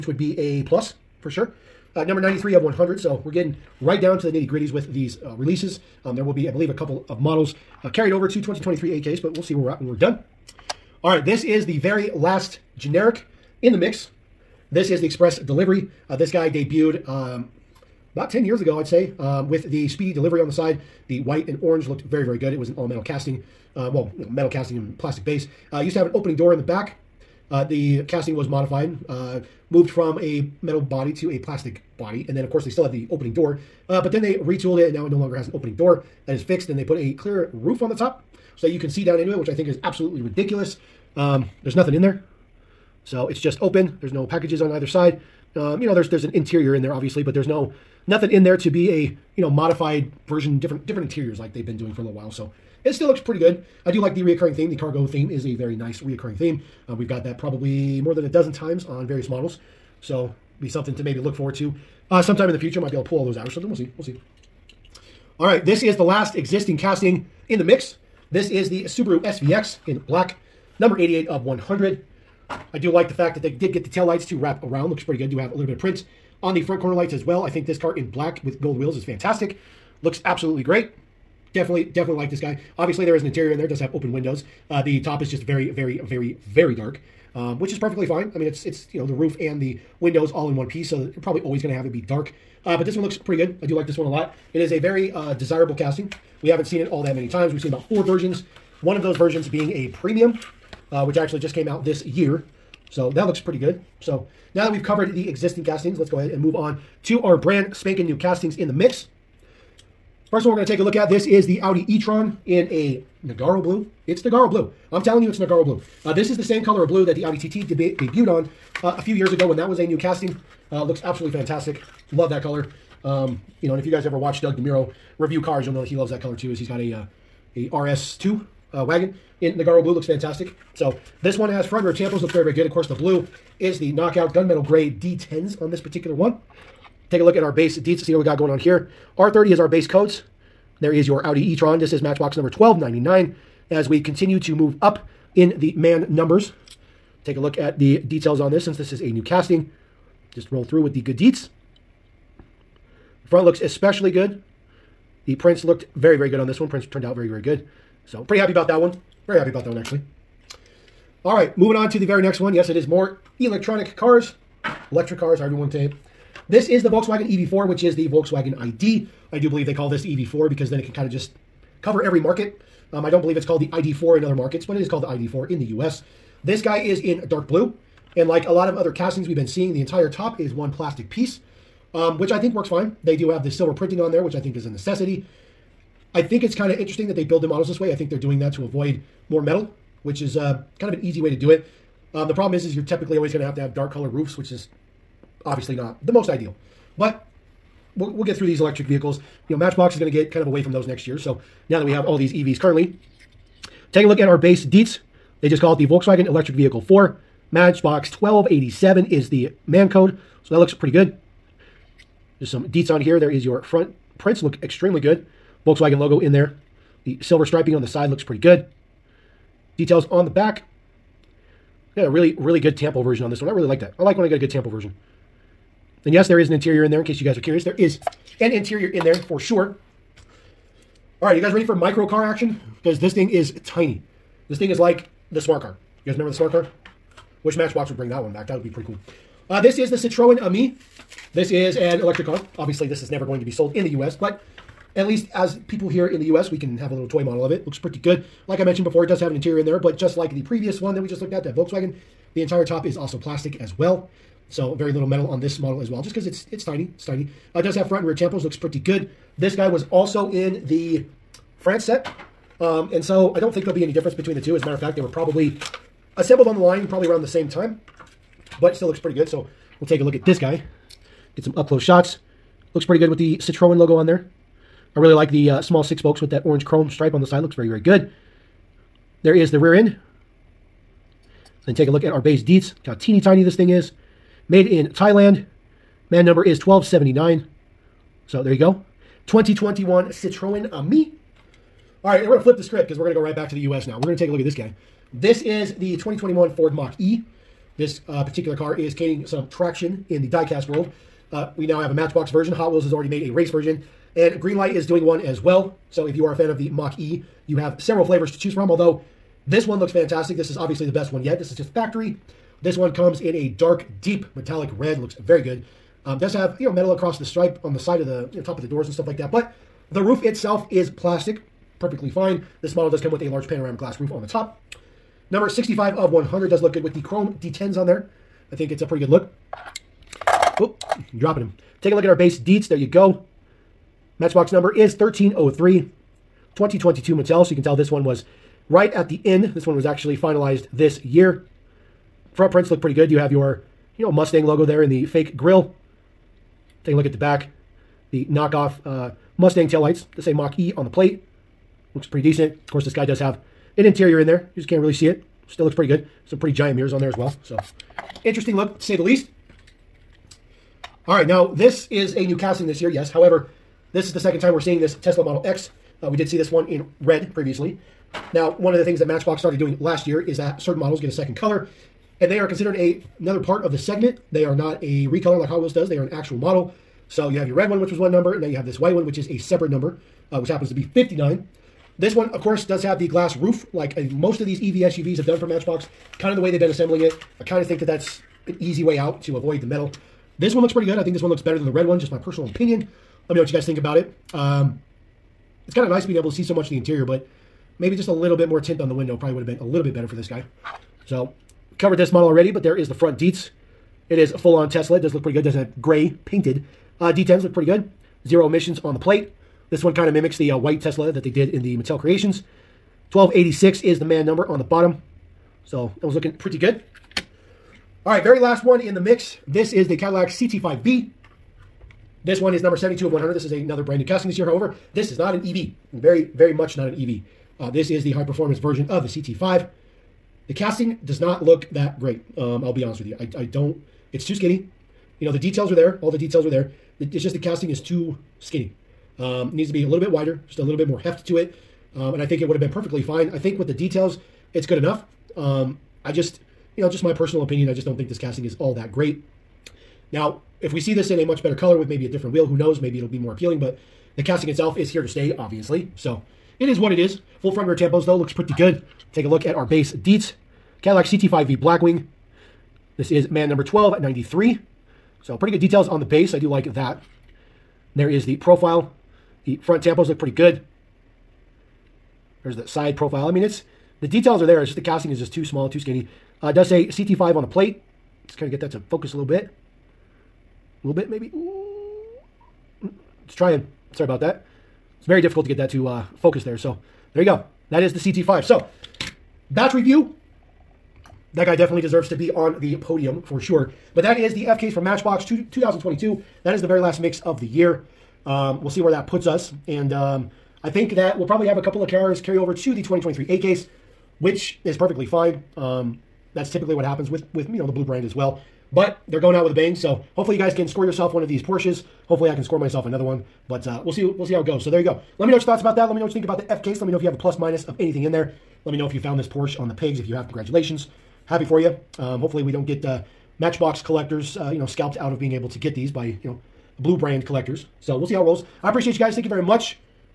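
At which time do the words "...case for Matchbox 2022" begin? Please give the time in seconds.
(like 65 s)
494 s.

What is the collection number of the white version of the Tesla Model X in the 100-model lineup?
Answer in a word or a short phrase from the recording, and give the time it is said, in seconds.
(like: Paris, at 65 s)
59, at 380 s.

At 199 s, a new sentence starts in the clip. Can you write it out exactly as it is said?
You know, Matchbox is going to get kind of away from those next year.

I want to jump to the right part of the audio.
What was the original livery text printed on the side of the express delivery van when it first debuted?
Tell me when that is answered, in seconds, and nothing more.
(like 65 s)
19 s.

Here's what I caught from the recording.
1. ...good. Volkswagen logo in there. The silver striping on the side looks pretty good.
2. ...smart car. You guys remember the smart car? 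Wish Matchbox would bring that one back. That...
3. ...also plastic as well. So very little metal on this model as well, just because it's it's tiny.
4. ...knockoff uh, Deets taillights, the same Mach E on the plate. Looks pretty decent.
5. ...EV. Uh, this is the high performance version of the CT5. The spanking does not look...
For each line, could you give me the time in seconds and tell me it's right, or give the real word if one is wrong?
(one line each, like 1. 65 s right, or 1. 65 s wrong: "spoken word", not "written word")
1. 214 s right
2. 235 s right
3. 252 s right
4. 348 s wrong: "Mustang", not "Deets"
5. 426 s wrong: "casting", not "spanking".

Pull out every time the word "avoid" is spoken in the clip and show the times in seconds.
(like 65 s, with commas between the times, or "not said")
188 s, 389 s.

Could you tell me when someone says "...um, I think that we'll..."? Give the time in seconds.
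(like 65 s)
499 s.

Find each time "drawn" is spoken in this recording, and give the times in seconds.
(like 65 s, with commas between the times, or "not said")
not said.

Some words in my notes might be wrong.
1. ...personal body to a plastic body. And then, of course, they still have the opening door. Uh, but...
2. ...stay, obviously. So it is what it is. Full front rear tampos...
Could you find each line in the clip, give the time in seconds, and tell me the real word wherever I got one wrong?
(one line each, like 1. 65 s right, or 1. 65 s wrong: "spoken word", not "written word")
1. 30 s wrong: "metal", not "personal"
2. 455 s right.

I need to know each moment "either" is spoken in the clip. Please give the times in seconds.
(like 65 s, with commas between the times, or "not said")
44 s.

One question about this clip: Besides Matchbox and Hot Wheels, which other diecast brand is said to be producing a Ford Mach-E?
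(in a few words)
Greenlight.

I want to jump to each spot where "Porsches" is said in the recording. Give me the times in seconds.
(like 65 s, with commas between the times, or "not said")
511 s, 519 s.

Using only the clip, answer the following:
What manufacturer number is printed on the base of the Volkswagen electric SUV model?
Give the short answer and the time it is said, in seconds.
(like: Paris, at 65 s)
1287, at 208 s.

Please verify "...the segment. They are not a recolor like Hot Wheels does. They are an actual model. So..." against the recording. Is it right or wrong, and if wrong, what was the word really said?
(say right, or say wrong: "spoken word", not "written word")
right.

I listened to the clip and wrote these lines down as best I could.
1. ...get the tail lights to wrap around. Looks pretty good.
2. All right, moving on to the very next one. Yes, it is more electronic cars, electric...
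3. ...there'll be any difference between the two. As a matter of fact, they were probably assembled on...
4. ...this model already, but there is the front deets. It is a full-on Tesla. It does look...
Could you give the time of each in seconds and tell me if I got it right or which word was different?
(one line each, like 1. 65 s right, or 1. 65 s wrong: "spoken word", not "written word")
1. 73 s right
2. 161 s right
3. 263 s right
4. 401 s right.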